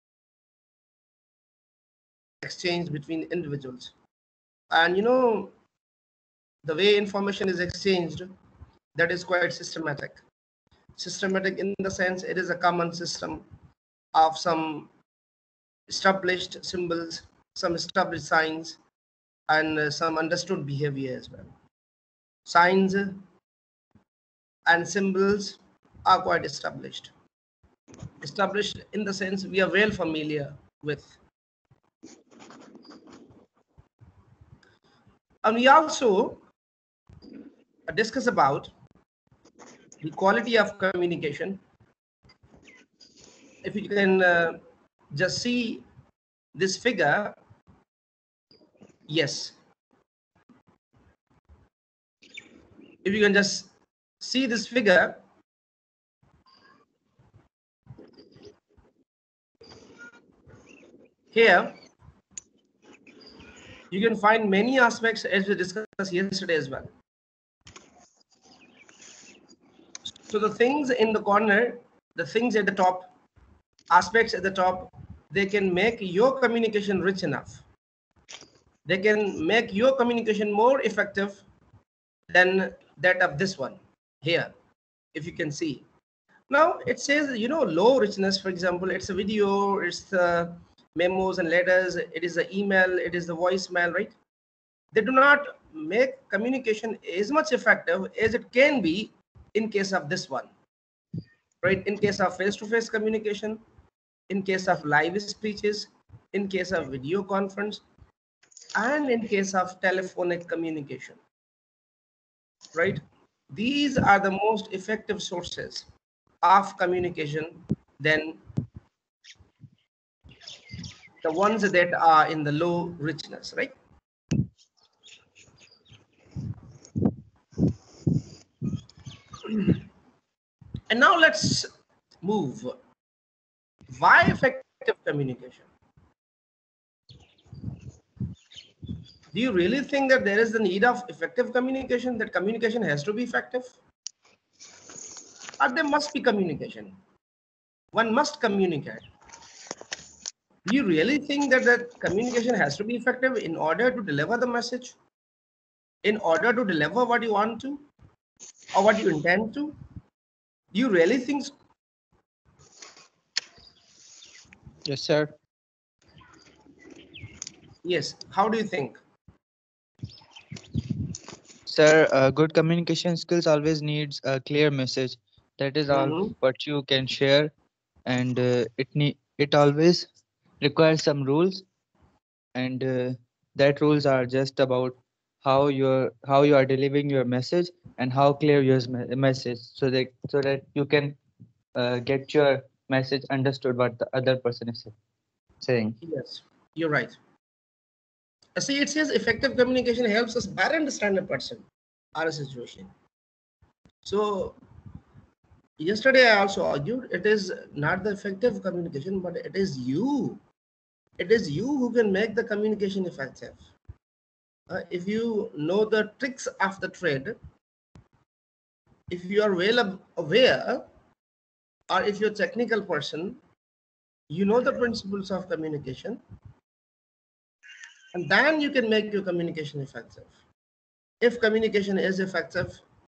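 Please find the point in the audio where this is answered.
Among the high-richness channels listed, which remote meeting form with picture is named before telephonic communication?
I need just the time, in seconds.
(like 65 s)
106 s.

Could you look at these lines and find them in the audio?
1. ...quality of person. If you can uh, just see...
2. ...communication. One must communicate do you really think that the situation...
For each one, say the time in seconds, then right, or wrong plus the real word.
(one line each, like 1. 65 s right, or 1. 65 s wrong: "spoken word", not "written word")
1. 40 s wrong: "communication", not "person"
2. 146 s wrong: "communication", not "situation".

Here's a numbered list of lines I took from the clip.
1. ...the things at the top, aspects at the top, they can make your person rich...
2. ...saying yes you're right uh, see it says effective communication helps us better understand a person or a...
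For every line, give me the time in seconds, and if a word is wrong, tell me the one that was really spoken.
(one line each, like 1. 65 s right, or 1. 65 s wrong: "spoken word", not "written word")
1. 72 s wrong: "communication", not "person"
2. 195 s right.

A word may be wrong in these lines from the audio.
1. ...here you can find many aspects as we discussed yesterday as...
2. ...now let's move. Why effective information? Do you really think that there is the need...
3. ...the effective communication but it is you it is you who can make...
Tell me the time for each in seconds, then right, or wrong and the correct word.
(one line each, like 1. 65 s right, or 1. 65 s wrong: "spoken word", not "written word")
1. 61 s right
2. 130 s wrong: "communication", not "information"
3. 208 s right.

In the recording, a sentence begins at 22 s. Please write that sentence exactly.
Signs and symbols are quite established.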